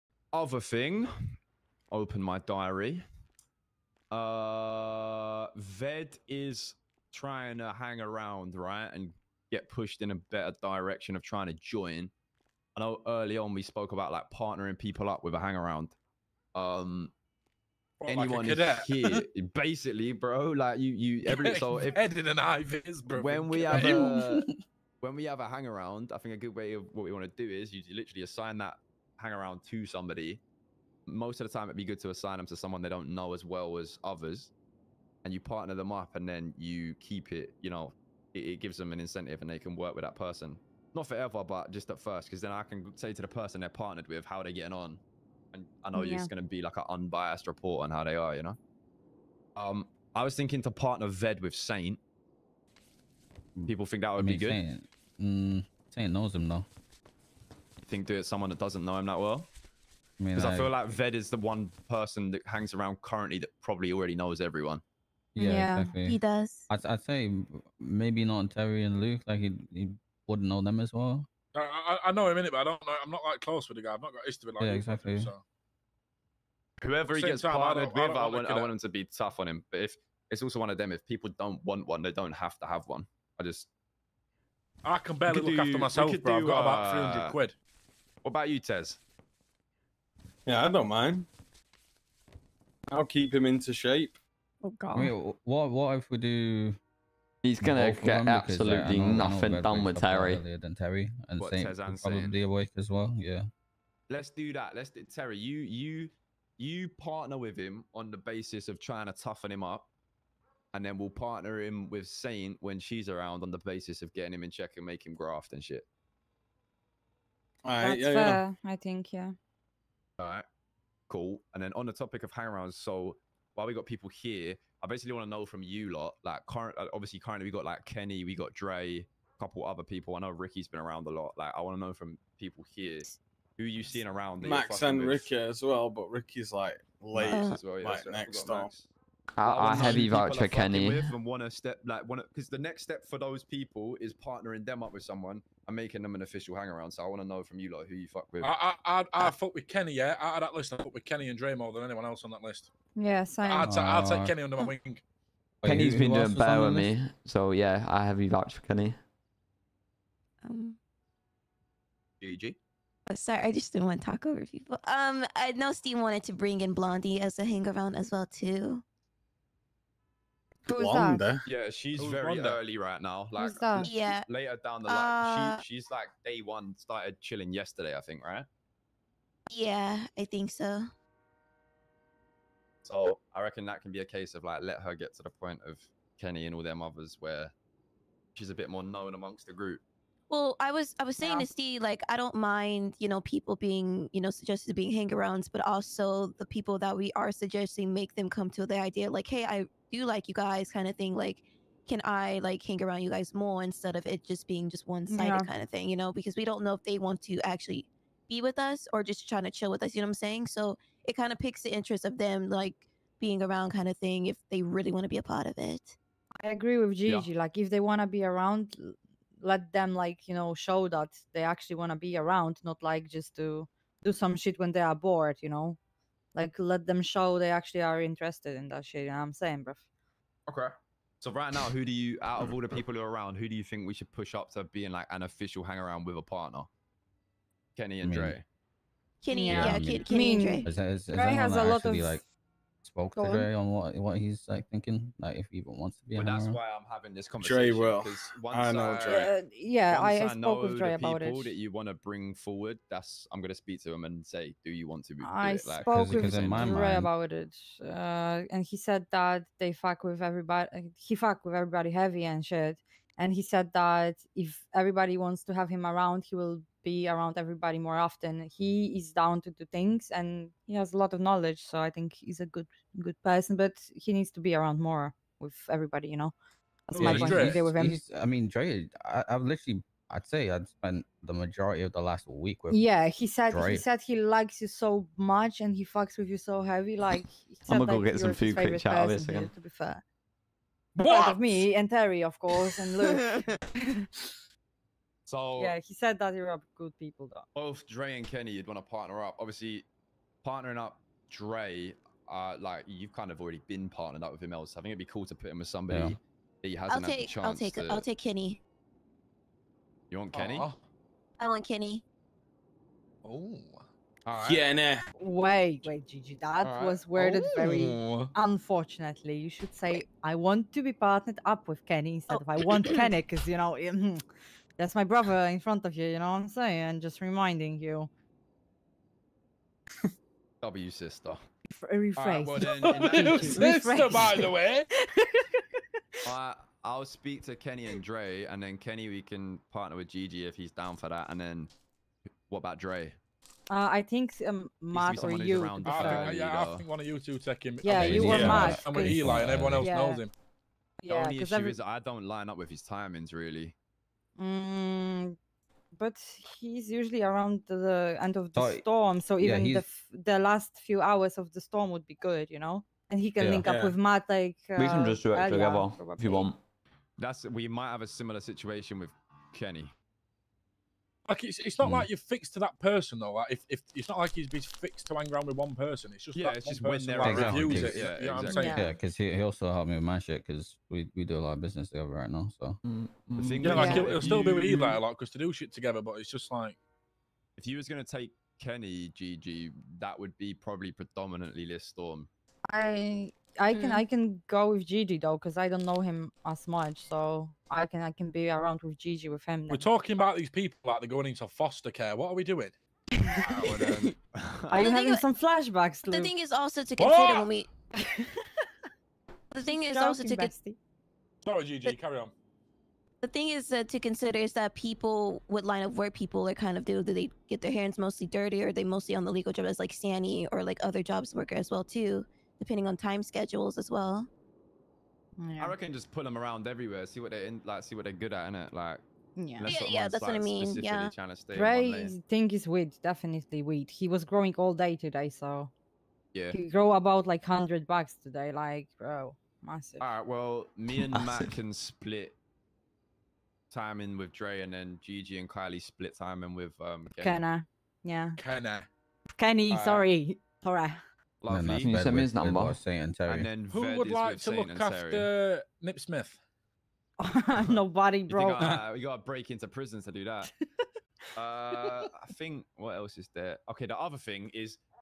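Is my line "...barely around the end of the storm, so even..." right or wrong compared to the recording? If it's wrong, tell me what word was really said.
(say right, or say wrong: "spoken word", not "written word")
wrong: "usually", not "barely".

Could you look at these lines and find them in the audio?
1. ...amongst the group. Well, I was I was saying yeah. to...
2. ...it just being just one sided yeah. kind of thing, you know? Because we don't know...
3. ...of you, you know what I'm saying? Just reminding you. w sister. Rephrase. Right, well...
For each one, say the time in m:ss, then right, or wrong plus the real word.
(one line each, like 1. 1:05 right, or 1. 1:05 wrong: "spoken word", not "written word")
1. 3:09 right
2. 3:24 right
3. 5:25 right.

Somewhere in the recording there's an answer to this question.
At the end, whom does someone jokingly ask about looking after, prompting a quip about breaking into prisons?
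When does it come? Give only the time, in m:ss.
7:35.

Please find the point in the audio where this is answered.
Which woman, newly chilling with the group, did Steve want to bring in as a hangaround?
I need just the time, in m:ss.
2:46.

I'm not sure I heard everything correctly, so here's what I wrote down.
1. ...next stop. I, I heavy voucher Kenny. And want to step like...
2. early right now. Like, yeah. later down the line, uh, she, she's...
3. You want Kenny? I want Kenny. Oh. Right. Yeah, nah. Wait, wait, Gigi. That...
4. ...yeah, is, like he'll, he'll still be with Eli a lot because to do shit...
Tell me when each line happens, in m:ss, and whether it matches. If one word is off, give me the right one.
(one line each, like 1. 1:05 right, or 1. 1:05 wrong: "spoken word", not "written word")
1. 2:18 right
2. 2:52 right
3. 5:10 right
4. 6:23 right.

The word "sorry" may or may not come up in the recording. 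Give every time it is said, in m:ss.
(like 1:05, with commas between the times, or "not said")
2:43, 6:51, 7:29.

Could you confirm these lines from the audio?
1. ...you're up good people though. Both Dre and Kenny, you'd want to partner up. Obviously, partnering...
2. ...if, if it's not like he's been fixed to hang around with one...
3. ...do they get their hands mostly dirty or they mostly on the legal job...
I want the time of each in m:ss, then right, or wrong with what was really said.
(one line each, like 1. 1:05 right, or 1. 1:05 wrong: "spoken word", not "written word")
1. 4:56 right
2. 6:13 right
3. 6:57 right.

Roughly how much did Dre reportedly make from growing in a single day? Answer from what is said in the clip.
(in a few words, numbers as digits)
100 bucks.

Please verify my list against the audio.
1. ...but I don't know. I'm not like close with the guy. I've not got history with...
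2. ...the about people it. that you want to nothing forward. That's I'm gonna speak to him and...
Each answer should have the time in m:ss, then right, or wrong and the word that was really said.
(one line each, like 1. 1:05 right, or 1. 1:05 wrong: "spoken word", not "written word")
1. 1:12 right
2. 4:10 wrong: "bring", not "nothing".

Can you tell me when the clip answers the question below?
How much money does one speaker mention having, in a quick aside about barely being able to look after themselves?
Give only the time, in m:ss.
1:26.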